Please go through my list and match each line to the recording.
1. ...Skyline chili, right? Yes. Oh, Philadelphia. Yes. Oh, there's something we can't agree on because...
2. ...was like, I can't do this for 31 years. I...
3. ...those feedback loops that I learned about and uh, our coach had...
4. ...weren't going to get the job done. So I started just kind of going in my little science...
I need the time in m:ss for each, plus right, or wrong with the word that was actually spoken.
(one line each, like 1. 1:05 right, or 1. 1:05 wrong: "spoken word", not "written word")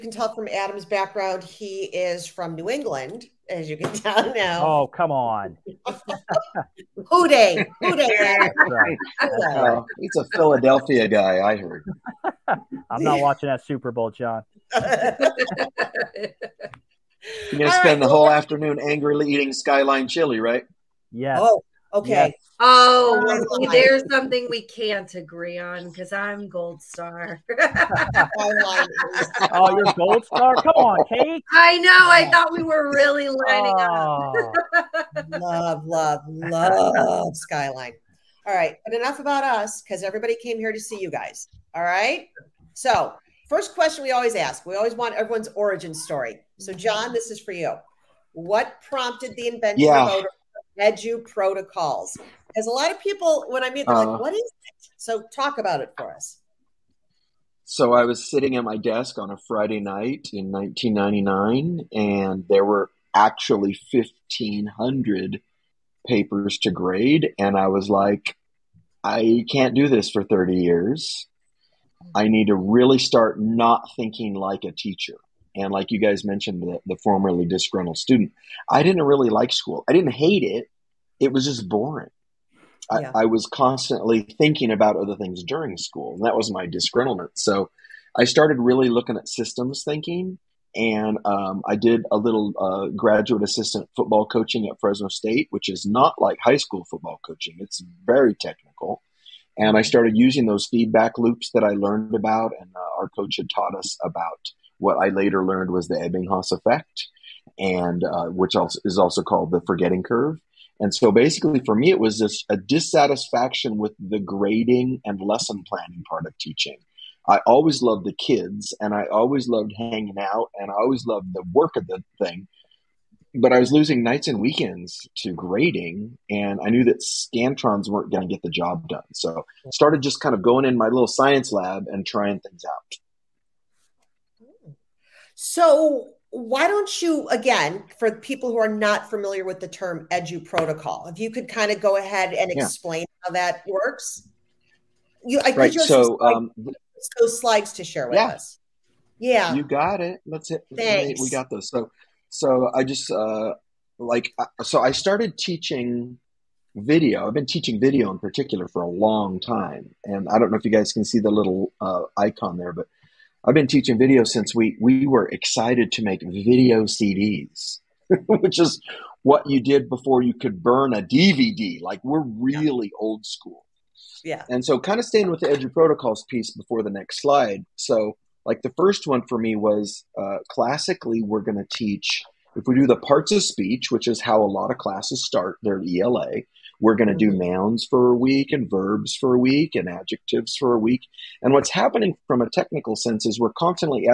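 1. 0:19 wrong: "Okay", not "Philadelphia"
2. 1:07 wrong: "30", not "31"
3. 1:40 right
4. 2:07 right.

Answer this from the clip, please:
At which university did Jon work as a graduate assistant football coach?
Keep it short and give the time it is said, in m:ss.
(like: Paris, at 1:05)
Fresno State, at 1:34.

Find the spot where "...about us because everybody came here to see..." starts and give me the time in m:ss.
0:39.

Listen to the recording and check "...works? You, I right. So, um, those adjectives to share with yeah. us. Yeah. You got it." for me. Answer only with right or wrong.
wrong.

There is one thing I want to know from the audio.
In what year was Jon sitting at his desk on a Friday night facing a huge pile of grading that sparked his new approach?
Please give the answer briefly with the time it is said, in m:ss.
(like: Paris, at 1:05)
1999, at 1:00.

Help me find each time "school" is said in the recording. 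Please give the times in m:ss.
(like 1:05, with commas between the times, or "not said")
1:19, 1:25, 1:36, 2:53.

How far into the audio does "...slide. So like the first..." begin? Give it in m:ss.
2:57.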